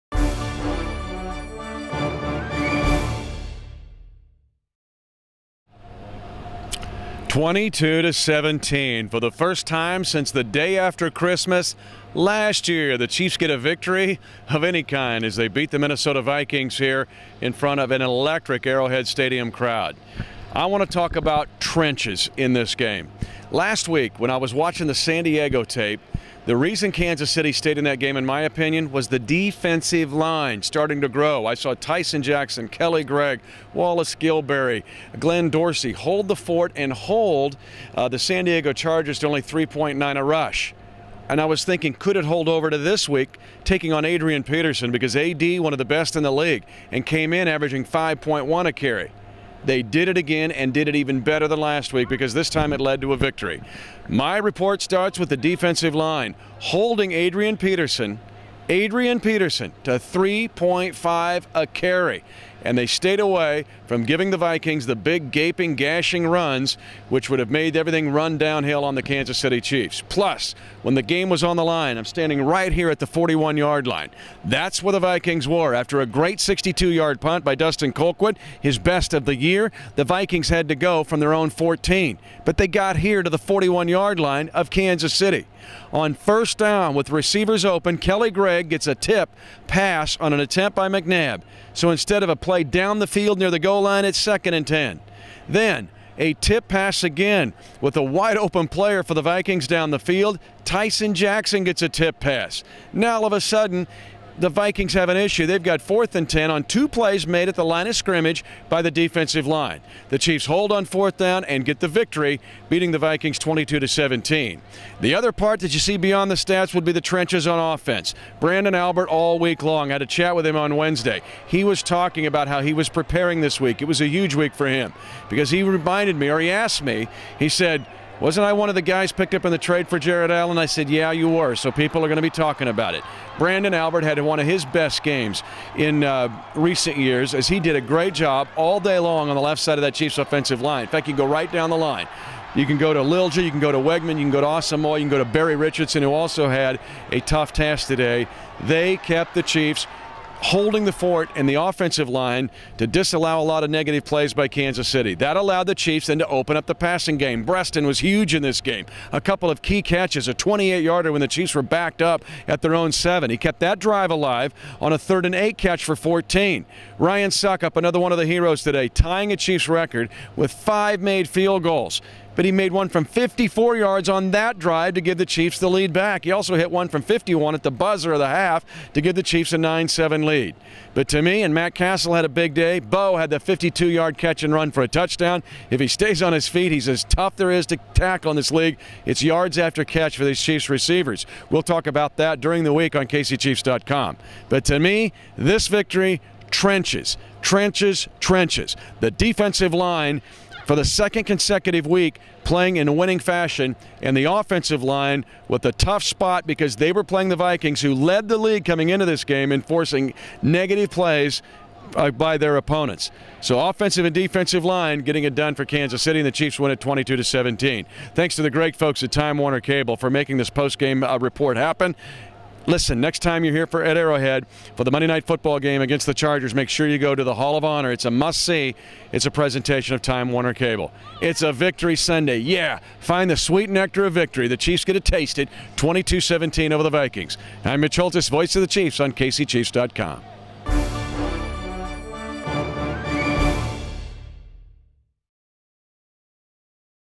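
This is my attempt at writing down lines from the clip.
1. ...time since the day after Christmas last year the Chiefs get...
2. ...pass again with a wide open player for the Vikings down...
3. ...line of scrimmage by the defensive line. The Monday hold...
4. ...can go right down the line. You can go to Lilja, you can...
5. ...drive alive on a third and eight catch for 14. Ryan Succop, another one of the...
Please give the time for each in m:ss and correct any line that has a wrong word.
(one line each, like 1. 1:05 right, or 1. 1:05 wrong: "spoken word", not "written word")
1. 0:09 right
2. 1:36 right
3. 1:47 wrong: "Chiefs", not "Monday"
4. 2:21 right
5. 2:43 right.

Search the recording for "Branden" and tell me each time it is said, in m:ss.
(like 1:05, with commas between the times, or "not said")
1:58, 2:13.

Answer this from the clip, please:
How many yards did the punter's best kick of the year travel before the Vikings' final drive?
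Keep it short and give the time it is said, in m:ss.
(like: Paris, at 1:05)
62, at 1:16.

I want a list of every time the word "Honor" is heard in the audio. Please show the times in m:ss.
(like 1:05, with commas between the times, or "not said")
3:47.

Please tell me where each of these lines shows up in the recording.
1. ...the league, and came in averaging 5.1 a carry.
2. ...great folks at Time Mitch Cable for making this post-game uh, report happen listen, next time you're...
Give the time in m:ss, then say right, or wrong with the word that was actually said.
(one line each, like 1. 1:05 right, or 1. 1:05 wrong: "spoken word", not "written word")
1. 0:46 right
2. 3:38 wrong: "Warner", not "Mitch".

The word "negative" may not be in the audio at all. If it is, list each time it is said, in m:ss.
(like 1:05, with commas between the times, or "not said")
2:33, 3:30.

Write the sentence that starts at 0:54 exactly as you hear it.
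My report starts with the defensive line holding Adrian Peterson Adrian Peterson to 3.5 a carry.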